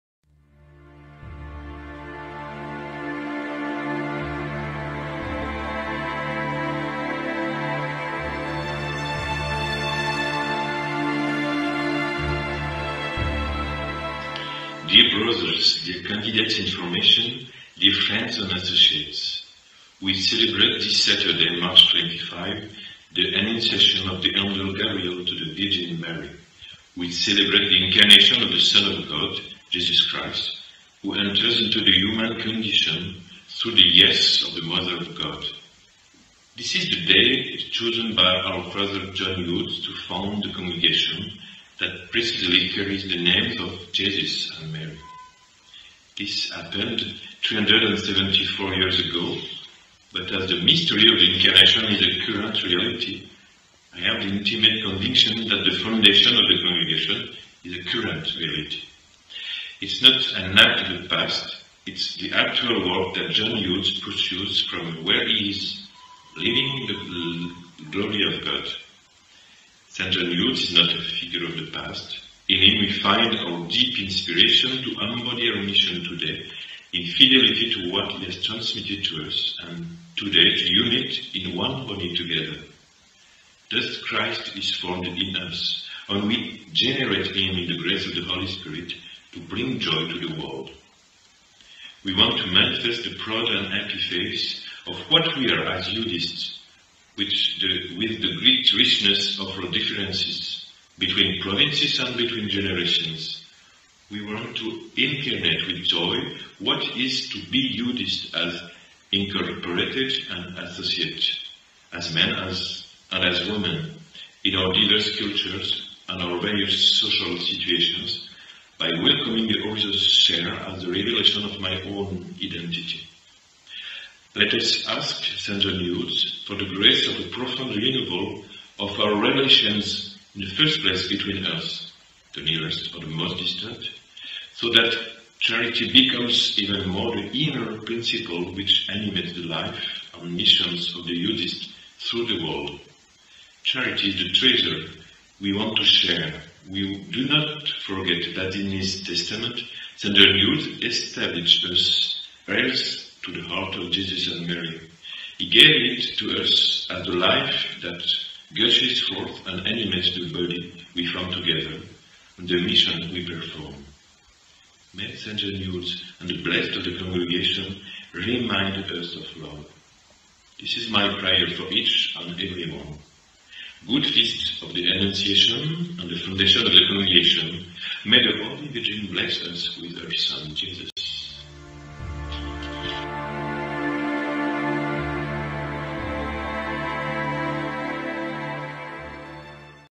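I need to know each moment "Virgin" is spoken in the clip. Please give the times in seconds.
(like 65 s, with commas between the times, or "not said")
25 s, 178 s.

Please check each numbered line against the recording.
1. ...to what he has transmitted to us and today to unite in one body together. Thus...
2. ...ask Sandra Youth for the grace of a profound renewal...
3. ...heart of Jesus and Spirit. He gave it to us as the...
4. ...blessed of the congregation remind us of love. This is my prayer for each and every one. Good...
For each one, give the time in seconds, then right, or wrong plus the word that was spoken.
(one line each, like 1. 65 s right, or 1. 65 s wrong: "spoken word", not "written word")
1. 77 s right
2. 124 s right
3. 153 s wrong: "Mary", not "Spirit"
4. 166 s right.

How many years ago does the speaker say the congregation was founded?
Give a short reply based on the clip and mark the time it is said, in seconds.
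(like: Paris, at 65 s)
374, at 47 s.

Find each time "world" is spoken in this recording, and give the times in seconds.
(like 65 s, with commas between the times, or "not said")
90 s, 142 s.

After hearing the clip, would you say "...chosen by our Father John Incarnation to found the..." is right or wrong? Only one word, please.
wrong.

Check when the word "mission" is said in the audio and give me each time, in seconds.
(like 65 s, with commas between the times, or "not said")
75 s, 140 s, 162 s.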